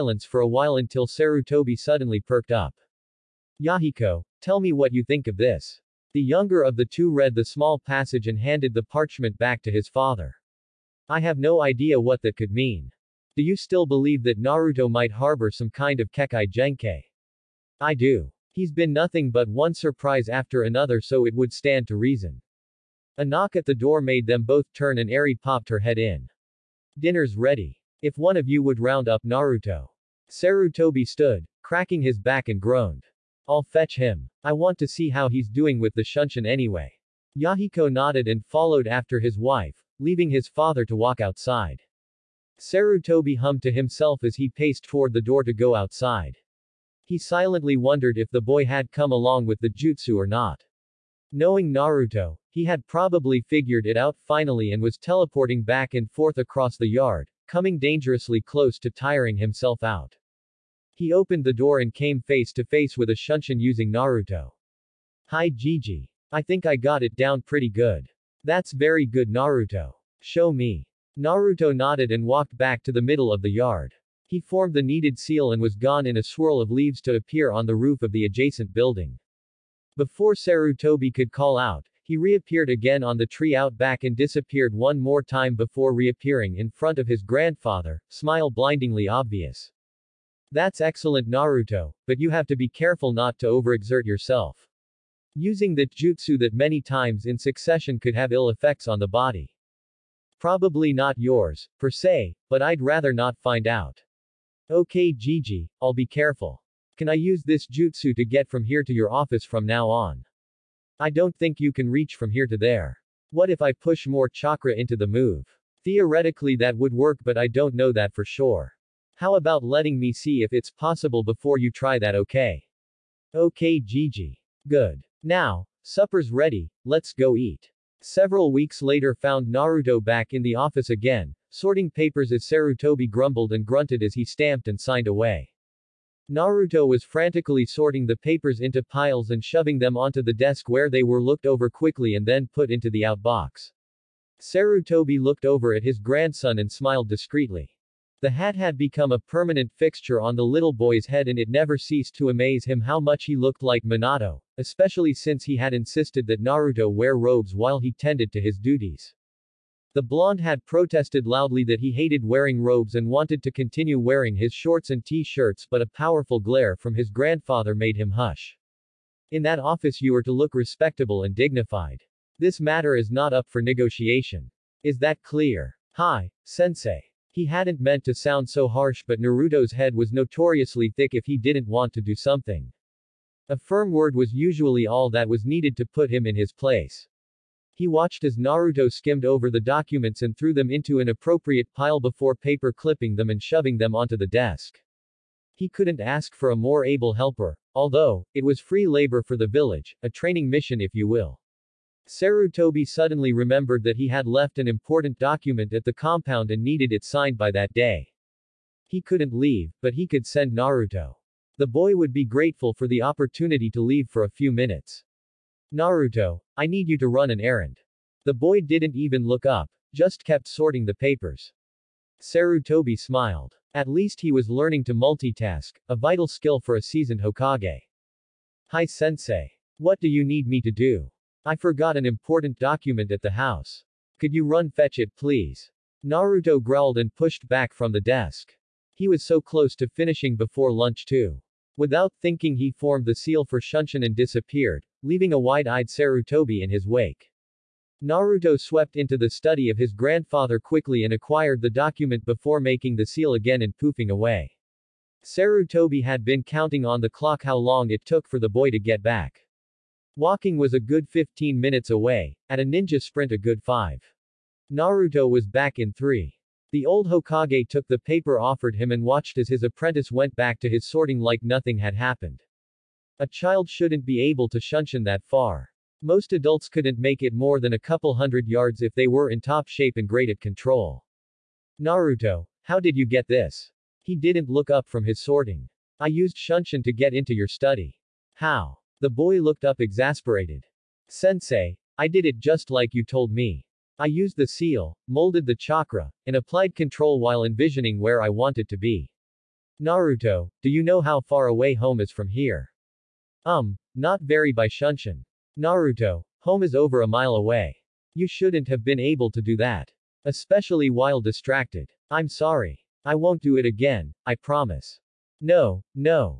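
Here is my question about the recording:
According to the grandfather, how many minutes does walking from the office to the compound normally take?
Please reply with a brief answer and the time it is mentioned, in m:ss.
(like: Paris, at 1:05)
15, at 4:21.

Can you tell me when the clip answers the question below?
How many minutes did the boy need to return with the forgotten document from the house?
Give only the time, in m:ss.
4:25.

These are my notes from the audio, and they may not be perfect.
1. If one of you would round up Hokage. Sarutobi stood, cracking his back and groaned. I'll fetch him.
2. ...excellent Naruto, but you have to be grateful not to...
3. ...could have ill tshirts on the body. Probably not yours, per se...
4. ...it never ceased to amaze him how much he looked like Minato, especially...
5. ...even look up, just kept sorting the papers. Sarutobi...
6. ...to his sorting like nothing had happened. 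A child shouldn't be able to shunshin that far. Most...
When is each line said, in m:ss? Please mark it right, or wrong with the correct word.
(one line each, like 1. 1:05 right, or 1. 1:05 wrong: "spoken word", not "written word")
1. 0:28 wrong: "Naruto", not "Hokage"
2. 1:30 wrong: "careful", not "grateful"
3. 1:38 wrong: "effects", not "tshirts"
4. 2:31 right
5. 3:38 right
6. 4:30 right.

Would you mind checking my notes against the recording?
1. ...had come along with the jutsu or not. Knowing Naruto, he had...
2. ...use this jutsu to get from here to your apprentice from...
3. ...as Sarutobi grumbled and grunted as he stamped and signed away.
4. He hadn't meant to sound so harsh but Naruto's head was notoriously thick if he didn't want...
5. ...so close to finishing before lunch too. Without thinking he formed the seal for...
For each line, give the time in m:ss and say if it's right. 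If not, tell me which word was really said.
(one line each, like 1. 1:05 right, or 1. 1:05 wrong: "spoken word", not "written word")
1. 0:48 right
2. 1:47 wrong: "office", not "apprentice"
3. 2:12 right
4. 2:57 right
5. 3:59 right.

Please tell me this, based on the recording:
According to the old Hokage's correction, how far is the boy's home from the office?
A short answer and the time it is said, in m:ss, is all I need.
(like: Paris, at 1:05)
Over a mile, at 5:06.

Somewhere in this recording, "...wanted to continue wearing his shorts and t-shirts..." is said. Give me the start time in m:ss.
2:43.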